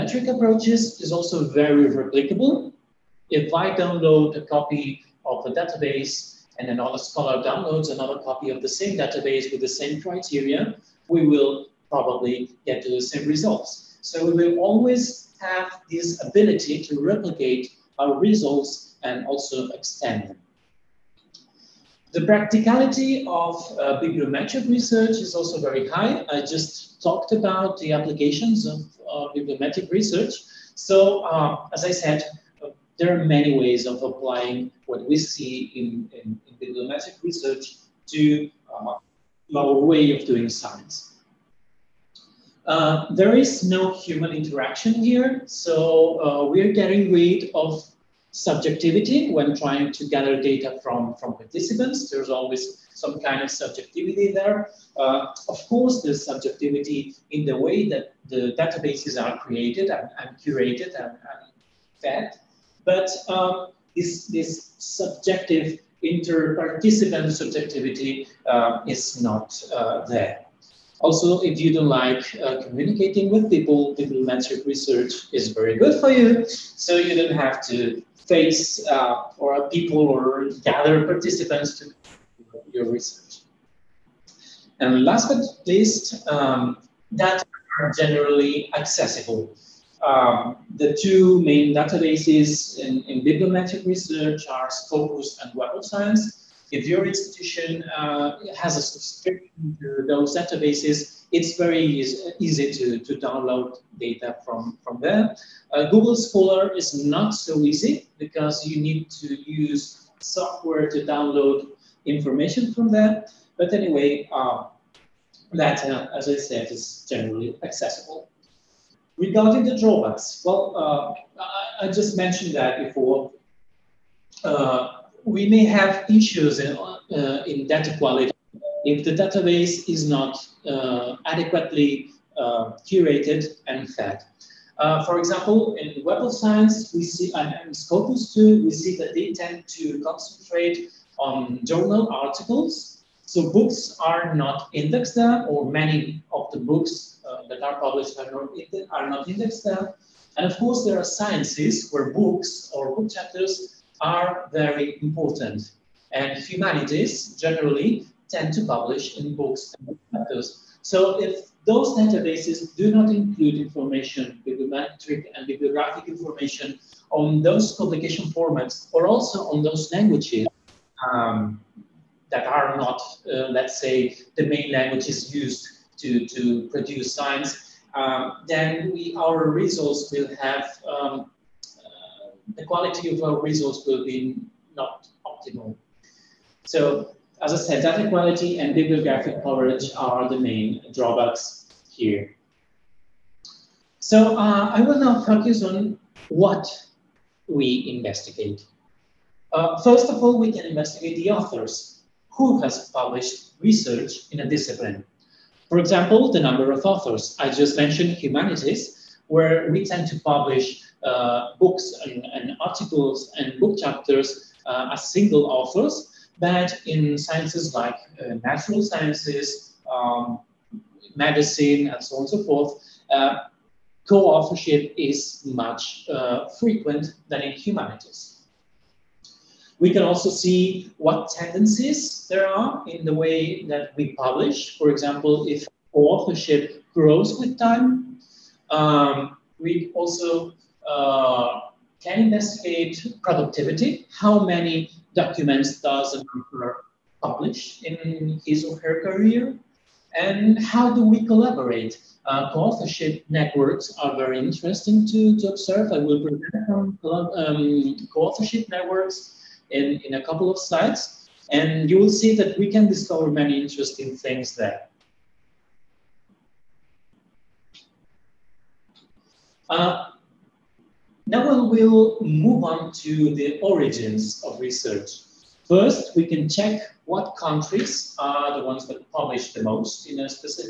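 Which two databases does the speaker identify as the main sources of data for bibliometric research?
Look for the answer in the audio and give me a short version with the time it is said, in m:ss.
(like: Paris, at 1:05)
Scopus and Web of Science, at 1:34.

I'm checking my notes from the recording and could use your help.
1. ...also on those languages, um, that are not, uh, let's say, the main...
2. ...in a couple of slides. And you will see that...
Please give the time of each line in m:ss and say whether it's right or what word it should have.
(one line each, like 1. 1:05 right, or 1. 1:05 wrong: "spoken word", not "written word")
1. 2:49 right
2. 4:20 right.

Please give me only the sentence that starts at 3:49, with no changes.
We can also see what tendencies there are in the way that we publish.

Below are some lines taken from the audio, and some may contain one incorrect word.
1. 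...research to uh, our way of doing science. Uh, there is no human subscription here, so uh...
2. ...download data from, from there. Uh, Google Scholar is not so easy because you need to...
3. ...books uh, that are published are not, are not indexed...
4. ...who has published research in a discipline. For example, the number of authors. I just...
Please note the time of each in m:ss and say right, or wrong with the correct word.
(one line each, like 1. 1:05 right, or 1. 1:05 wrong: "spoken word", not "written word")
1. 0:37 wrong: "interaction", not "subscription"
2. 1:43 right
3. 2:26 right
4. 3:22 right.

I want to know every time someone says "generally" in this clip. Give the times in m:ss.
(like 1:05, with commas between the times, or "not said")
1:27, 1:57, 2:37.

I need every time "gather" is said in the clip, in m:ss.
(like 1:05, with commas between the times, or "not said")
0:50, 1:20.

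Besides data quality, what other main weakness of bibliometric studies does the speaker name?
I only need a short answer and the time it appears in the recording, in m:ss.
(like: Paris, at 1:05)
Bibliographic coverage, at 3:08.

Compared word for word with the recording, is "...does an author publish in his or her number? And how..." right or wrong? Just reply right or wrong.
wrong.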